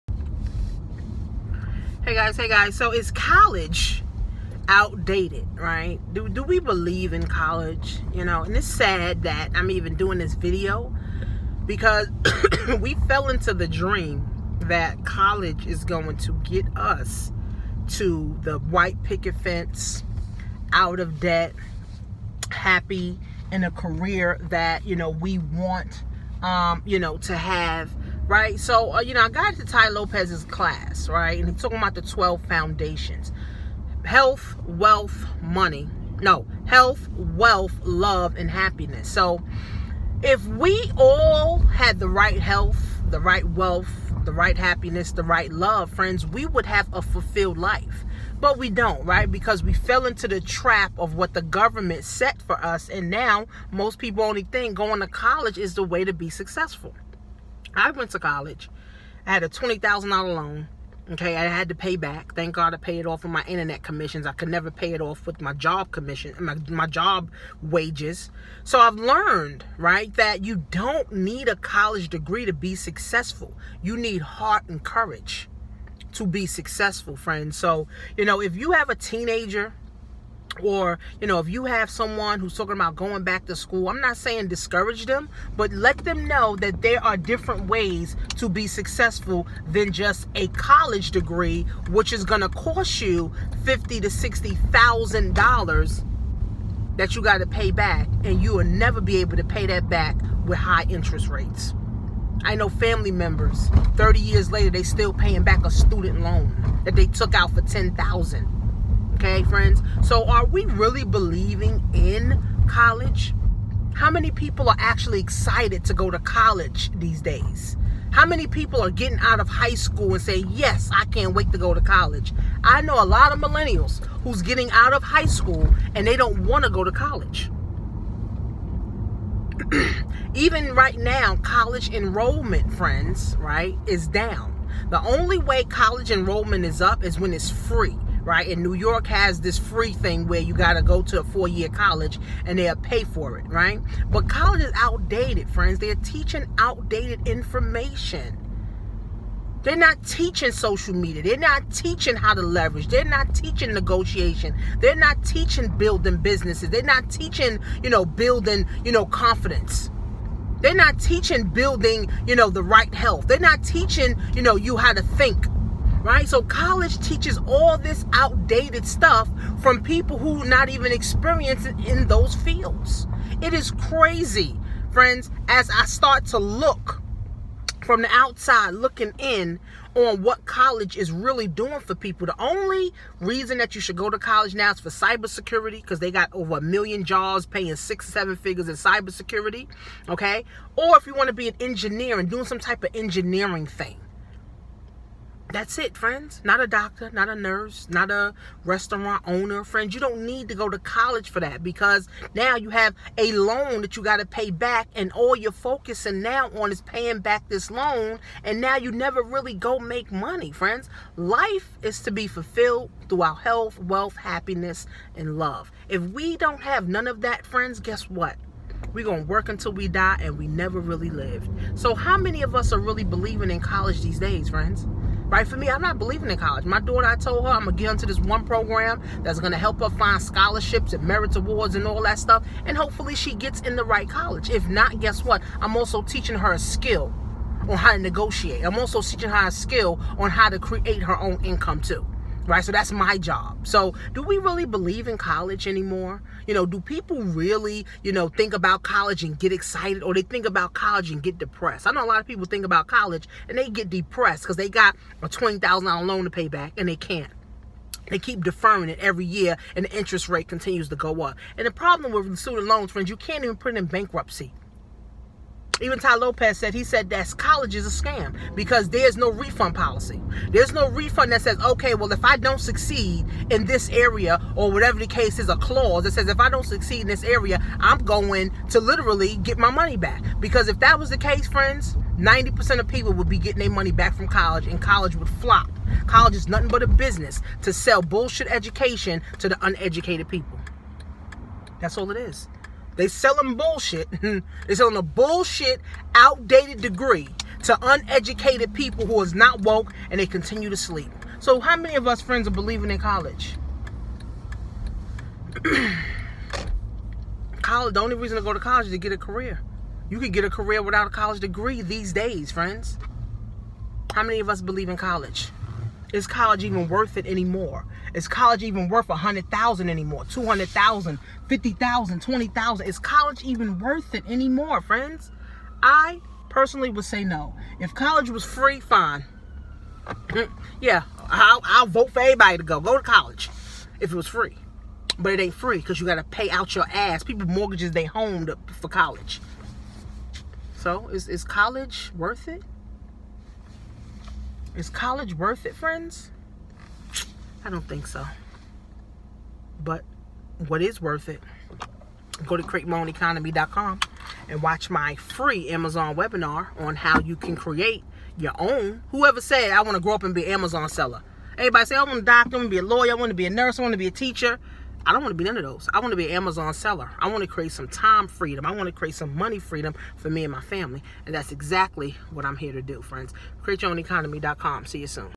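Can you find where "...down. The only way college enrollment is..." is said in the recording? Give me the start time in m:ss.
2:14.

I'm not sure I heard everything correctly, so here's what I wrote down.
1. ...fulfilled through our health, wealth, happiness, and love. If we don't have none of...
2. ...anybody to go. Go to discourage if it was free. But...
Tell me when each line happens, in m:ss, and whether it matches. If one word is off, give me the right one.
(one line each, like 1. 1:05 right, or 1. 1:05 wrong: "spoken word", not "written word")
1. 3:32 right
2. 5:32 wrong: "college", not "discourage".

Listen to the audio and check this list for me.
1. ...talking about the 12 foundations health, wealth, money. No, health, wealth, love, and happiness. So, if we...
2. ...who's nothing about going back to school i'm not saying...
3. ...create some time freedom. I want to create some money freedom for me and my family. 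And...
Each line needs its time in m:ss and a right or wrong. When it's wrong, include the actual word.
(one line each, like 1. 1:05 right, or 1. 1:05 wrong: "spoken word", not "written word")
1. 0:31 right
2. 1:22 wrong: "talking", not "nothing"
3. 6:07 right.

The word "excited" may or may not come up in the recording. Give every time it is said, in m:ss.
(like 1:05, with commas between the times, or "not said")
1:55, 4:09.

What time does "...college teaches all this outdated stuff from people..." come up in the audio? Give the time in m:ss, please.
2:46.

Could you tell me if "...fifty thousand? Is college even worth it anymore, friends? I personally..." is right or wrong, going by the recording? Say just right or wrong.
wrong.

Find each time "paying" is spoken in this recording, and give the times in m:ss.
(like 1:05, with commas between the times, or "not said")
1:45, 3:07, 3:26.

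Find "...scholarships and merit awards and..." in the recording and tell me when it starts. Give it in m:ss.
3:50.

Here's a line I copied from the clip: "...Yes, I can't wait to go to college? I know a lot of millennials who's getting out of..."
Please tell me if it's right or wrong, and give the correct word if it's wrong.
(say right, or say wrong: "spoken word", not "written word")
right.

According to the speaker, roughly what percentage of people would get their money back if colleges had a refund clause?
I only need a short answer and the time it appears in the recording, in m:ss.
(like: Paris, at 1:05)
90%, at 4:42.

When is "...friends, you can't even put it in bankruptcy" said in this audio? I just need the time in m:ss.
4:22.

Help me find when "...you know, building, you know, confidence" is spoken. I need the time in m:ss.
2:37.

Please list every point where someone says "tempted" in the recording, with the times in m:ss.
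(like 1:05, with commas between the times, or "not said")
not said.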